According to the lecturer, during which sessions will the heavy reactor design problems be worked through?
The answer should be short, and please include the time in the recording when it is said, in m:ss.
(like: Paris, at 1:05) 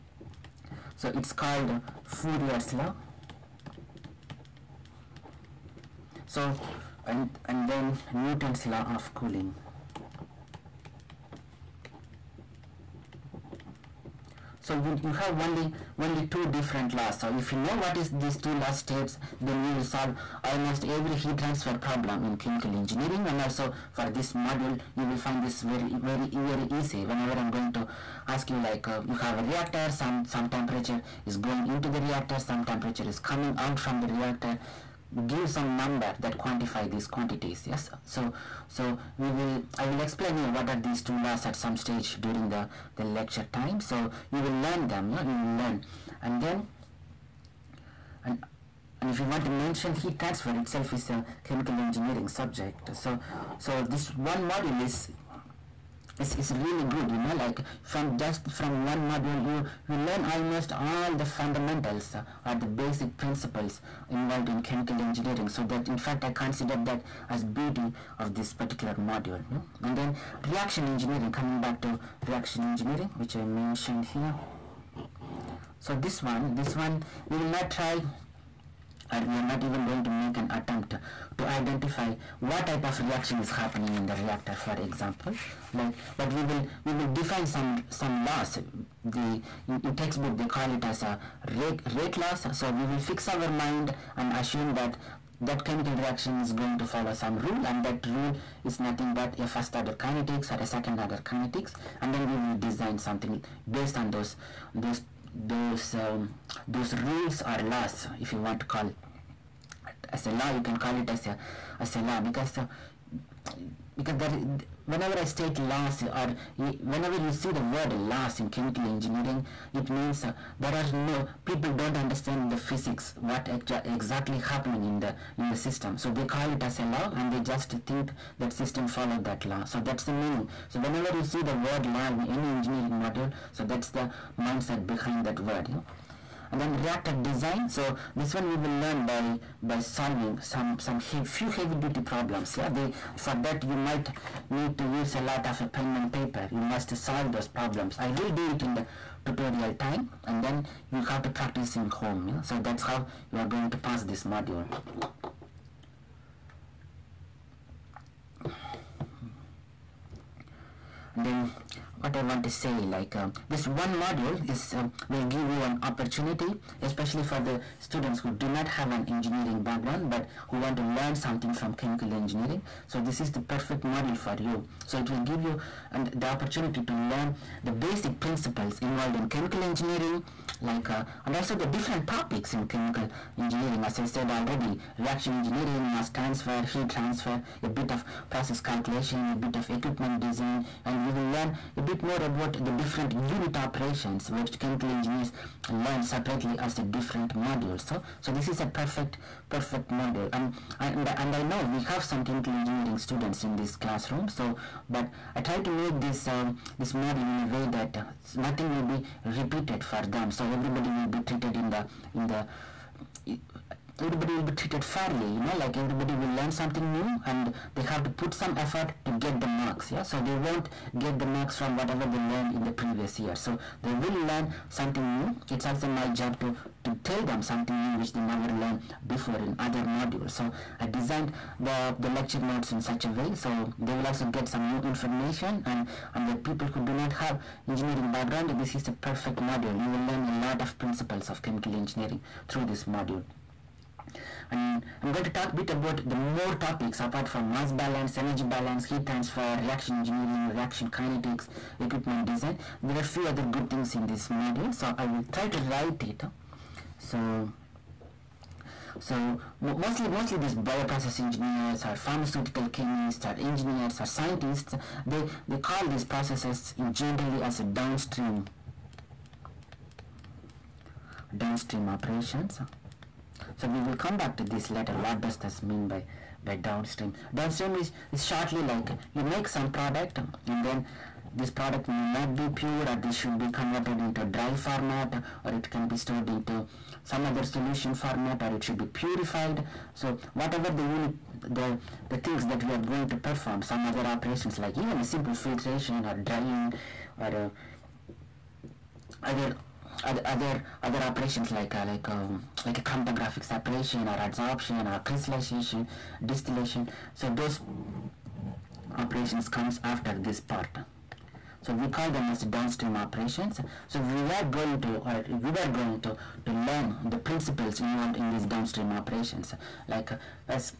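tutorial time, at 2:28.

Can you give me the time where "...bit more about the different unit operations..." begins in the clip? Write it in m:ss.
3:11.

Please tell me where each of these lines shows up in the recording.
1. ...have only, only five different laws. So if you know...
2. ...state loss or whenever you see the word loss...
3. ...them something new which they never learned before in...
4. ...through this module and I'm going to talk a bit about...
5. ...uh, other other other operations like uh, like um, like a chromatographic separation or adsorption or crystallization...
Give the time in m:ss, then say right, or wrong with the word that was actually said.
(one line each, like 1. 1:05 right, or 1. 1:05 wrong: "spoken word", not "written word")
1. 0:15 wrong: "two", not "five"
2. 1:55 right
3. 3:47 right
4. 4:02 right
5. 4:59 right.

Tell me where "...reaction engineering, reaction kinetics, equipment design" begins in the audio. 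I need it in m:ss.
4:09.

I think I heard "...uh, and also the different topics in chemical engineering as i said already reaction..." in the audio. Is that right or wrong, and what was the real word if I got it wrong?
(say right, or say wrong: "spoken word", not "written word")
right.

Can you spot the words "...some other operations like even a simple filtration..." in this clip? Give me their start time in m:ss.
4:53.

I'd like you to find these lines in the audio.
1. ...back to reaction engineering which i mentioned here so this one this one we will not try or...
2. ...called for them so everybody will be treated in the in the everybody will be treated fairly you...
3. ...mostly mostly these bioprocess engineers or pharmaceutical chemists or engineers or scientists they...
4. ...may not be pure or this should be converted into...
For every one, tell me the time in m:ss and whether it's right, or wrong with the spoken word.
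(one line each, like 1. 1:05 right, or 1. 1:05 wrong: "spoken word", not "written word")
1. 1:11 right
2. 3:29 wrong: "repeated", not "called"
3. 4:19 right
4. 4:41 right.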